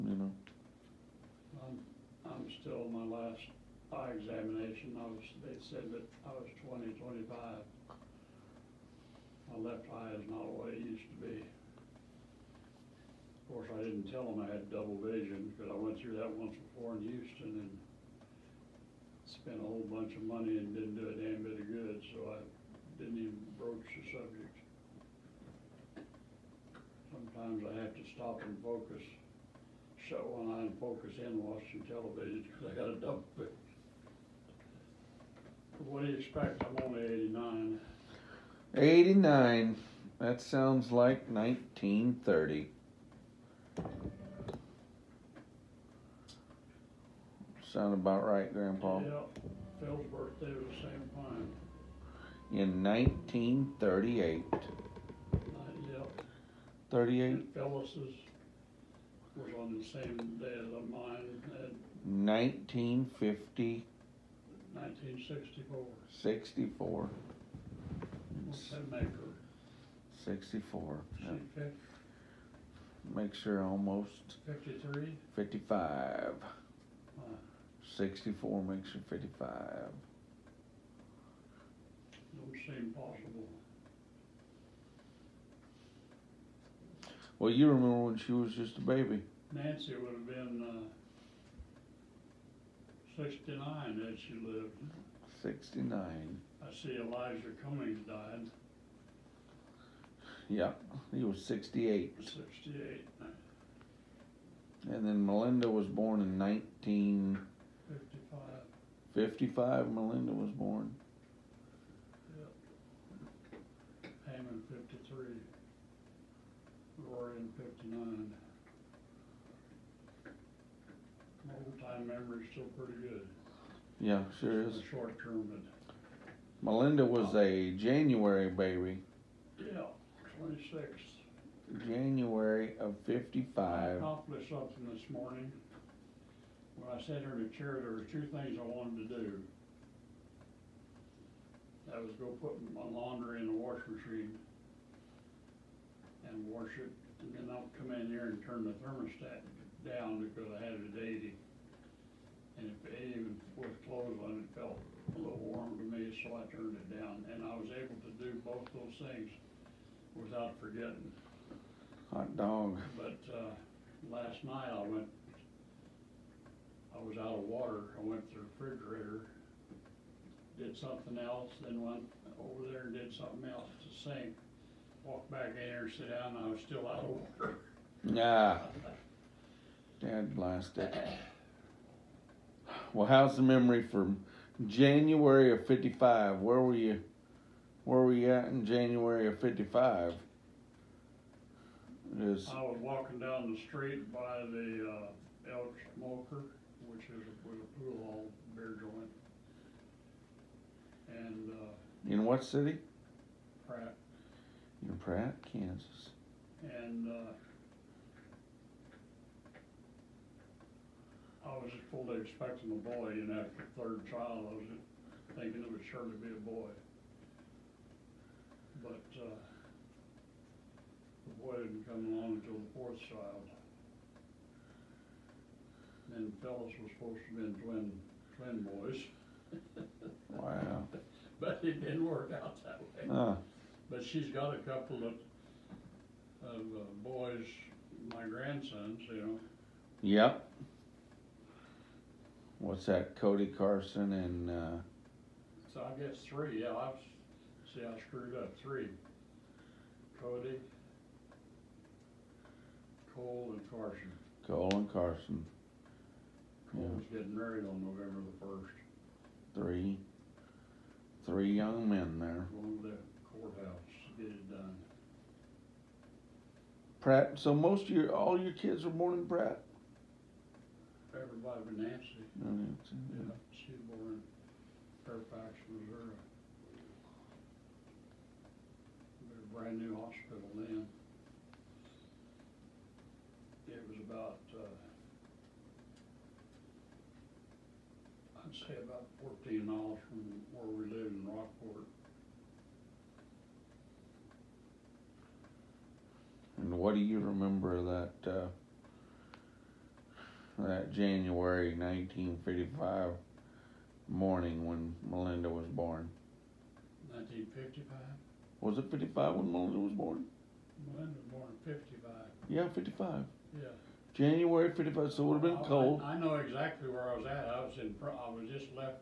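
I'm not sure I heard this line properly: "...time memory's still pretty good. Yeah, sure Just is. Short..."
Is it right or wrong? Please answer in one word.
right.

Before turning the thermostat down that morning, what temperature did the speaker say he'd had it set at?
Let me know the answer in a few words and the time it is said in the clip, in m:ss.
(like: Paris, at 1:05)
80, at 2:31.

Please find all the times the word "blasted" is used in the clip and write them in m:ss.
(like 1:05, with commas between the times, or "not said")
3:00.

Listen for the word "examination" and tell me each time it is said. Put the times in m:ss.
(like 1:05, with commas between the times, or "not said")
0:04.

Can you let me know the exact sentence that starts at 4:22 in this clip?
going to the courthouse, to get it done.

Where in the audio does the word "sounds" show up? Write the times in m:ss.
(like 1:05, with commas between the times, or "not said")
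0:40, 0:47.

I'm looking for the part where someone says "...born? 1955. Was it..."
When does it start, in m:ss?
5:05.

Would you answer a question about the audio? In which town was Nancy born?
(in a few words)
Fairfax.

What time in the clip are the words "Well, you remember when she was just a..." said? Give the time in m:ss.
1:27.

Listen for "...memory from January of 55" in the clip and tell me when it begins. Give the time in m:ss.
3:03.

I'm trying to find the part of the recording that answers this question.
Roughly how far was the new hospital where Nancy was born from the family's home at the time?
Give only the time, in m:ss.
4:44.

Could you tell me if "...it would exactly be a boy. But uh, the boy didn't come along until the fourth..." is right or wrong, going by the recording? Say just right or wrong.
wrong.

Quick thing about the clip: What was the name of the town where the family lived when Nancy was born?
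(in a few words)
Rock Port.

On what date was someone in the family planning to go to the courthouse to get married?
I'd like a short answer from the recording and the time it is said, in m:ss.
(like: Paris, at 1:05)
November 1, at 4:17.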